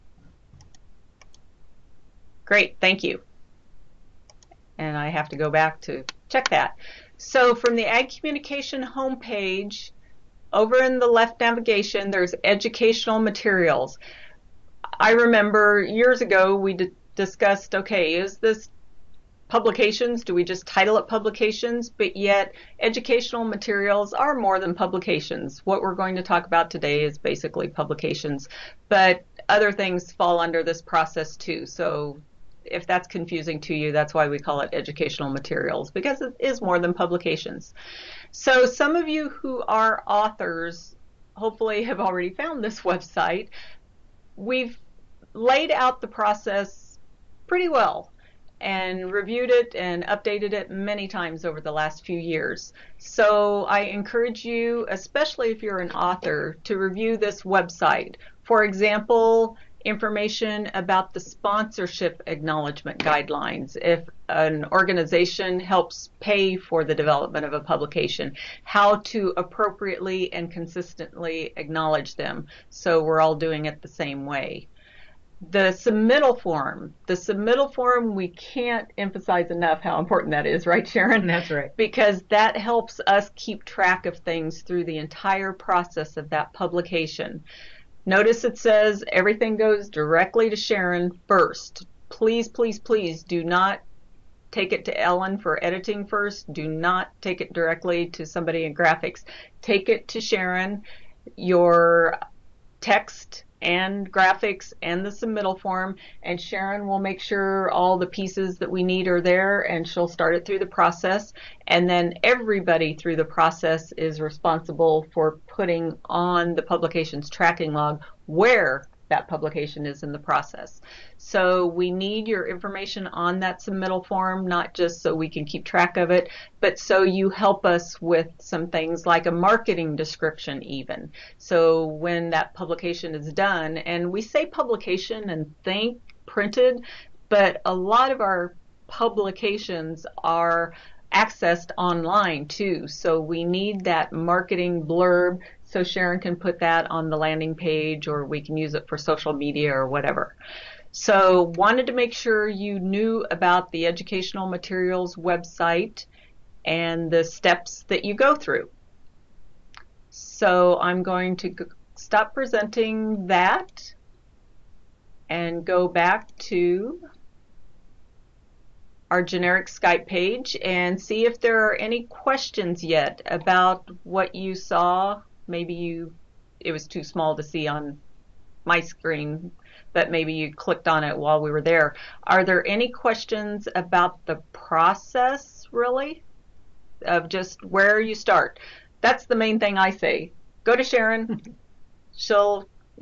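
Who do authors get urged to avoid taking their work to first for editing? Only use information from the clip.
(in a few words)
Ellen.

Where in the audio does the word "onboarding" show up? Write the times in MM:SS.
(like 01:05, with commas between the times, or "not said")
not said.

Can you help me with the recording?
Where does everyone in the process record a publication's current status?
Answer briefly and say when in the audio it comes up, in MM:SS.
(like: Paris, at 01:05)
Publications tracking log, at 01:56.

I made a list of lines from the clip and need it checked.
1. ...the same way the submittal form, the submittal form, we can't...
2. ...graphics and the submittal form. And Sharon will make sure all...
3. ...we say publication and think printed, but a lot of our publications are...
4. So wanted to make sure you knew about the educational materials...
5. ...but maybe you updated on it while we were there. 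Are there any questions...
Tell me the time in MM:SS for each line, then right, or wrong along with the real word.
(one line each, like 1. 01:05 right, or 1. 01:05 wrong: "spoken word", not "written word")
1. 01:13 right
2. 01:44 right
3. 02:14 right
4. 02:30 right
5. 02:59 wrong: "clicked", not "updated".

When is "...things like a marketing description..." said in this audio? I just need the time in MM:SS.
02:08.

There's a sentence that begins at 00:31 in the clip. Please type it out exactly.
So if that's confusing to you, that's why we call it educational materials because it is more than publications.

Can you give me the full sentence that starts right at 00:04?
And I have to go back to check that.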